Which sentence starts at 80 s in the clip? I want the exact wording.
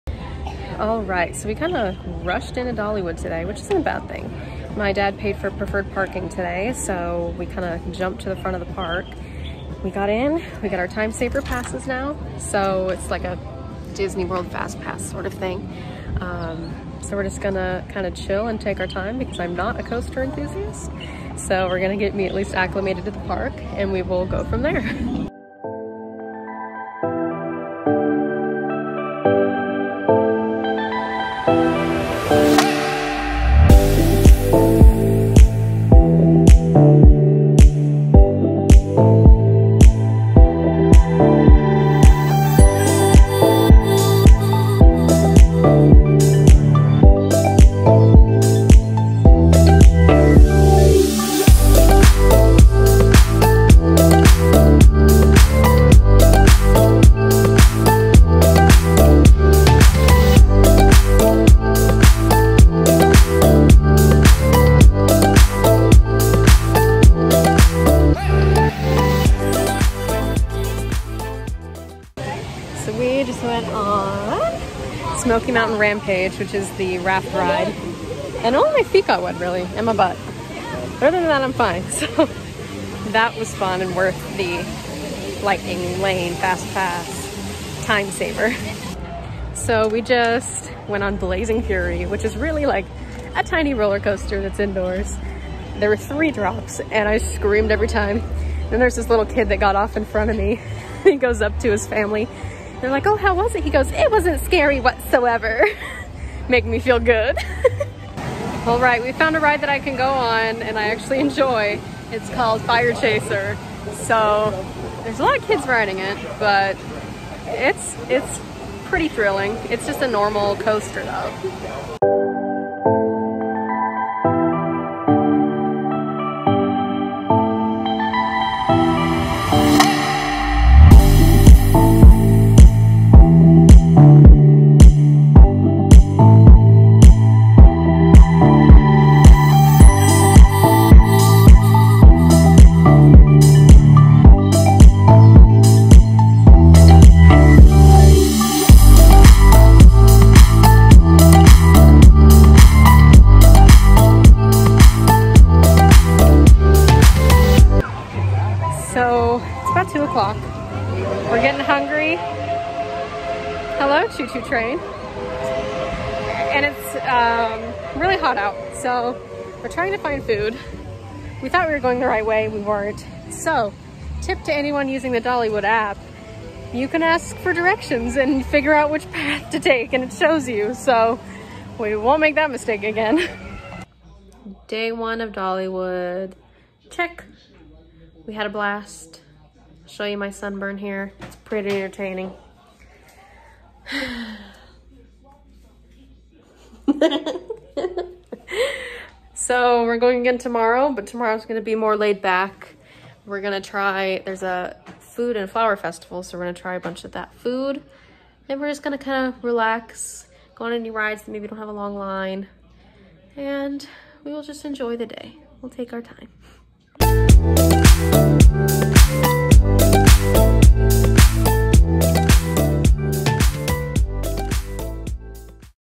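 But other than that, I'm fine.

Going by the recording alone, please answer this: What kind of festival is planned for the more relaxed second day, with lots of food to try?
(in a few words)
Food and flower festival.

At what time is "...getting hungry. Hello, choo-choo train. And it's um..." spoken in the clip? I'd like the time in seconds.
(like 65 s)
161 s.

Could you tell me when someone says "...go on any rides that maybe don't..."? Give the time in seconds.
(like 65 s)
210 s.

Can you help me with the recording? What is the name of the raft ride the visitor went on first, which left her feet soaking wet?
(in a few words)
Smoky Mountain Rampage.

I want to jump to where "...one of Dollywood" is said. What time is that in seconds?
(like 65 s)
184 s.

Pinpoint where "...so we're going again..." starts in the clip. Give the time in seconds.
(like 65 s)
199 s.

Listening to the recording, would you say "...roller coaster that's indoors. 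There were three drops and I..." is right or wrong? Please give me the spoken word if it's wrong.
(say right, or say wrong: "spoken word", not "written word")
right.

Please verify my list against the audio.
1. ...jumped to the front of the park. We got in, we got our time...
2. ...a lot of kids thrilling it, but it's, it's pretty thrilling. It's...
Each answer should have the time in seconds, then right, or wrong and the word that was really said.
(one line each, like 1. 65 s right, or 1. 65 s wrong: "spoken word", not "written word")
1. 7 s right
2. 115 s wrong: "riding", not "thrilling".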